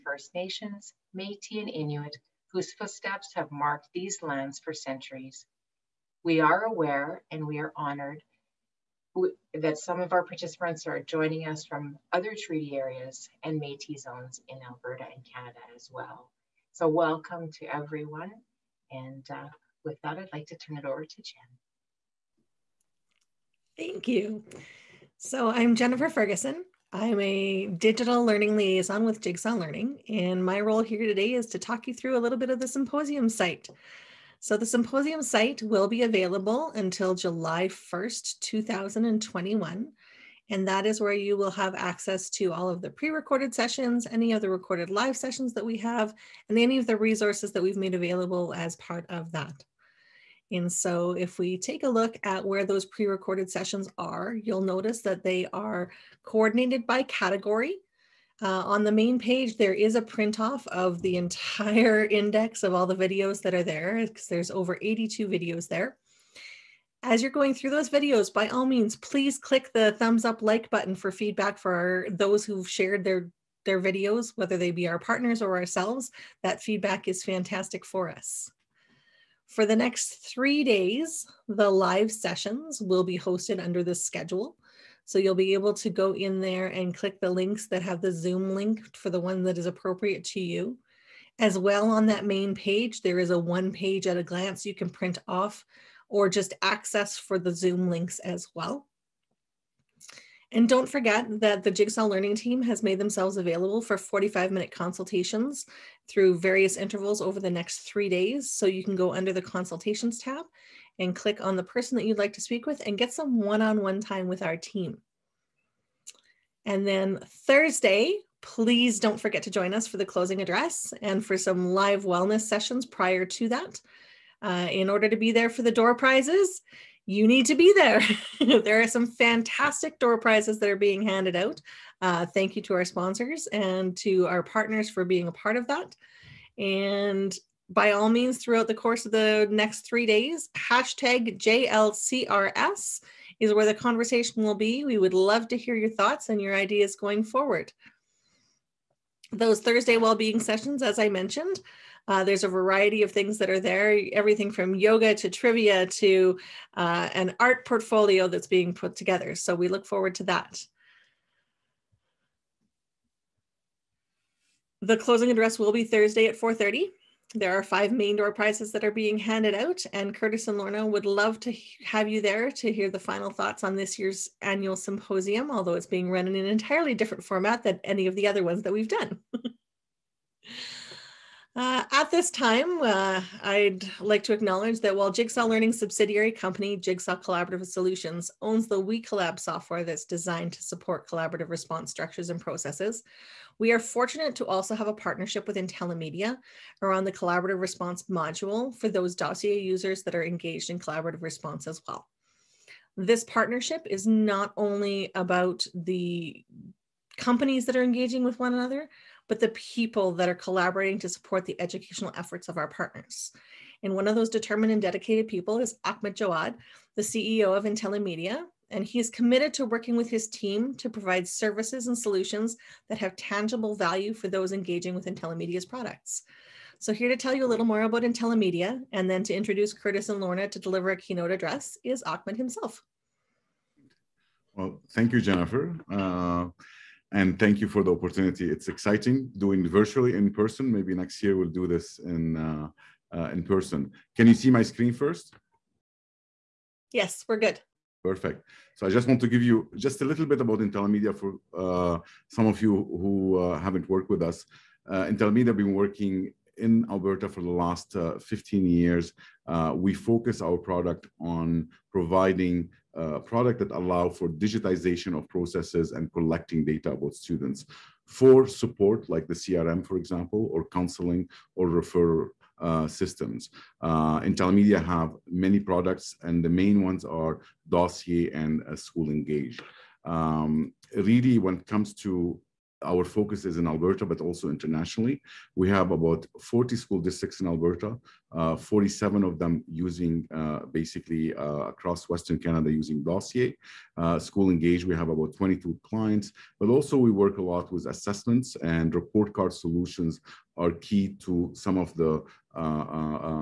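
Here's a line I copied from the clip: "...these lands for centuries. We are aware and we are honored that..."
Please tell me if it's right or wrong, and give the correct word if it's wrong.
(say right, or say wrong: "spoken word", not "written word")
right.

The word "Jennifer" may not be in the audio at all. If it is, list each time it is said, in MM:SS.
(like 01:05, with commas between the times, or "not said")
00:25, 03:55.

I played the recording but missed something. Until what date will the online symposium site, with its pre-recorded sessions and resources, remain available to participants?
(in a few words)
July 1st, 2021.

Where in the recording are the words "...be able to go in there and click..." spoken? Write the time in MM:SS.
01:25.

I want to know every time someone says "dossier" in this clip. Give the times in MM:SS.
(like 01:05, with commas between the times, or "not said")
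03:19, 04:37, 04:53.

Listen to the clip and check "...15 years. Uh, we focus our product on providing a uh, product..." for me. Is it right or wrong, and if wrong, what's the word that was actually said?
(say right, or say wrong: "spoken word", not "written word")
right.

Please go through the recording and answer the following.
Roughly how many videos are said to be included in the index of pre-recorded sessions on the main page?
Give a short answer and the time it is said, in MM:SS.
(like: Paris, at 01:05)
82, at 01:04.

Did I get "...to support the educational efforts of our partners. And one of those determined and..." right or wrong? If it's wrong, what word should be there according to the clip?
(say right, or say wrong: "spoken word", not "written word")
right.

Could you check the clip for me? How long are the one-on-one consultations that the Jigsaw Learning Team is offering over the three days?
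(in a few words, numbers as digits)
45 minutes.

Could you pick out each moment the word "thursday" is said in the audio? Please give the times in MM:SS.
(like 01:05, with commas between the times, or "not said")
01:57, 02:29, 02:45.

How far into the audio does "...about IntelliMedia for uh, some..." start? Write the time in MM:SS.
04:10.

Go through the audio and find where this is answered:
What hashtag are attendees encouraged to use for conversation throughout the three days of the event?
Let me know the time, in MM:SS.
02:21.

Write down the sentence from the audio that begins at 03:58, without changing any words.
It's exciting doing virtually in person.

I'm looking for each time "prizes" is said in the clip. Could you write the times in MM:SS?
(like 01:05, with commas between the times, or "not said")
02:05, 02:10, 02:48.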